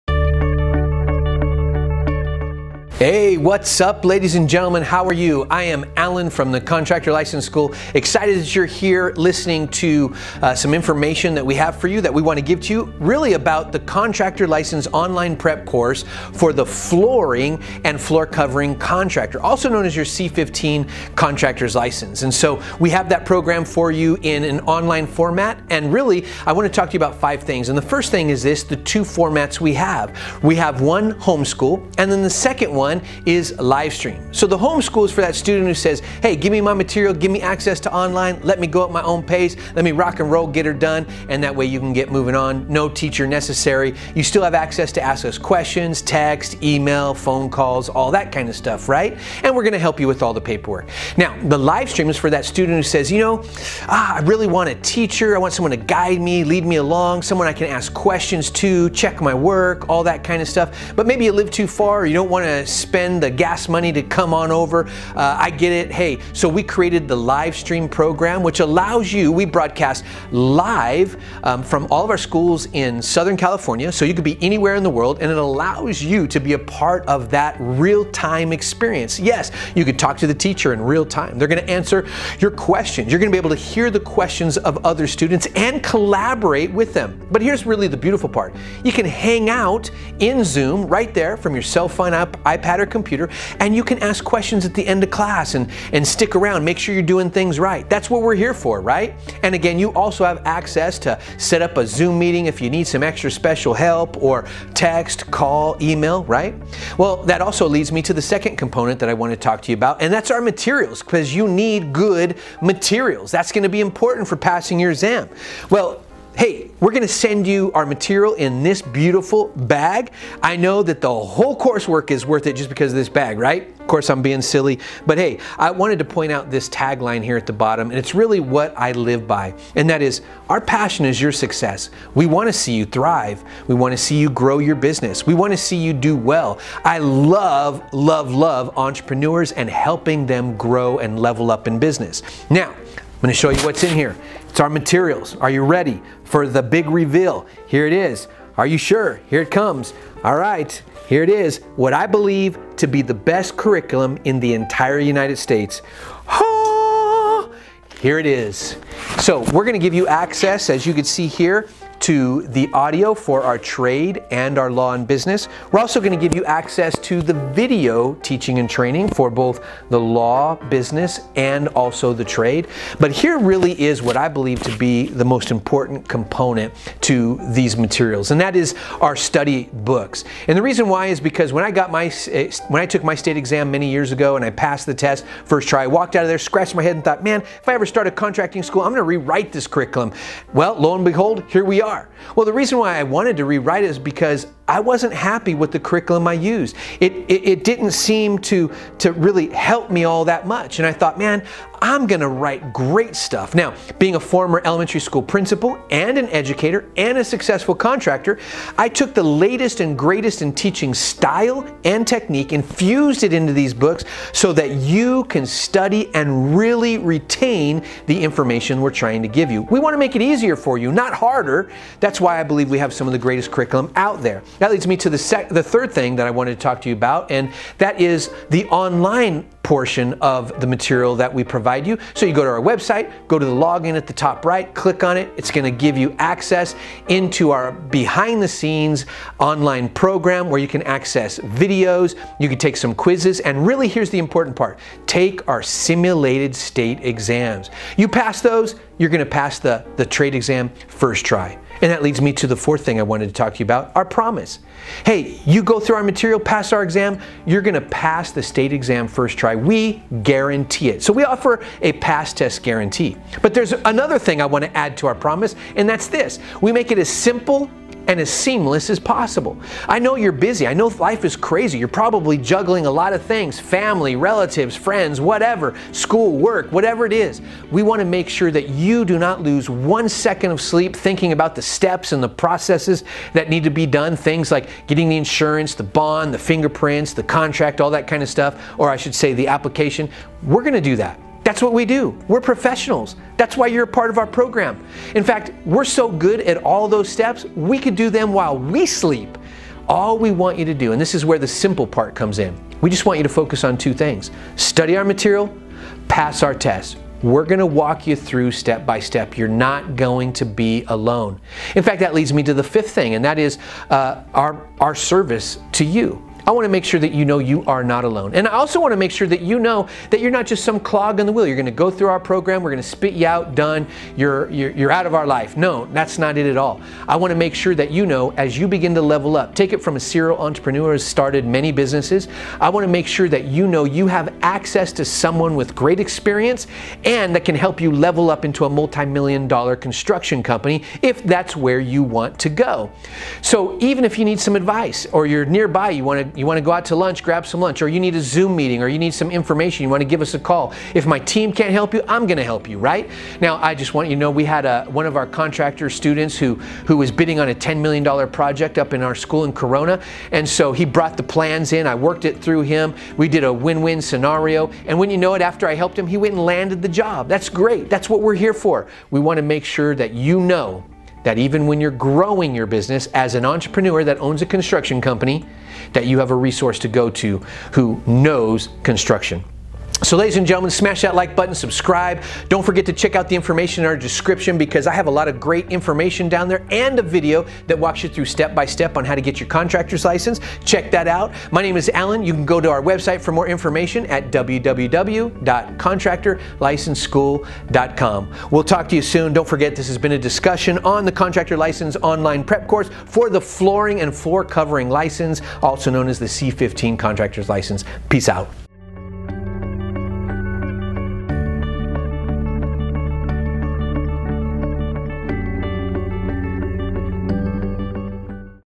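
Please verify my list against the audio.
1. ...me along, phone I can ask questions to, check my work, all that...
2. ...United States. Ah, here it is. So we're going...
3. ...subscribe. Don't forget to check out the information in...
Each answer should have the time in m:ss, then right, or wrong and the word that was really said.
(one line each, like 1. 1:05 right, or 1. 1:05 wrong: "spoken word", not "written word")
1. 0:56 wrong: "someone", not "phone"
2. 2:34 right
3. 6:21 right.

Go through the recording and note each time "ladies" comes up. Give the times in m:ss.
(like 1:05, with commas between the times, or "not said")
0:04, 6:20.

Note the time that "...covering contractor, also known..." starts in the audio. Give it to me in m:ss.
0:18.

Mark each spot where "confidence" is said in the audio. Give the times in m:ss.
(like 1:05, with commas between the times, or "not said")
not said.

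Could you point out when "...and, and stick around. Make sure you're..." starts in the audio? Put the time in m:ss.
1:35.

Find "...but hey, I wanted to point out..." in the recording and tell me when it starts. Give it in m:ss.
2:05.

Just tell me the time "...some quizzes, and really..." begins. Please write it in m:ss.
4:02.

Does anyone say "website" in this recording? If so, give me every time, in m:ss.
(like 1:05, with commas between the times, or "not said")
3:52, 6:32.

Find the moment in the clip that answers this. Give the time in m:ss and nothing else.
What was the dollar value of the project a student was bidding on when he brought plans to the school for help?
5:57.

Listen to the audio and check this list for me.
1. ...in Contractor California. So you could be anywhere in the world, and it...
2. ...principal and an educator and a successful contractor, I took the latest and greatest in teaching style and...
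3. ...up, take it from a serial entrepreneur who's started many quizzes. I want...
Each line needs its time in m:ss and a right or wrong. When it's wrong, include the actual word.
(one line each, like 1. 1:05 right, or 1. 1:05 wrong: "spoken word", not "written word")
1. 1:12 wrong: "Southern", not "Contractor"
2. 3:25 right
3. 5:29 wrong: "businesses", not "quizzes".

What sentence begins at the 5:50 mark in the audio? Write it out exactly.
If my team can't help you, I'm going to help you, right?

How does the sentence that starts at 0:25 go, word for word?
And really, I want to talk to you about five things.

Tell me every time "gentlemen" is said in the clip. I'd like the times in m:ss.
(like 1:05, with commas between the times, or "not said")
0:04, 6:20.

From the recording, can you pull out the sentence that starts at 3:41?
That's why I believe we have some of the greatest curriculum out there.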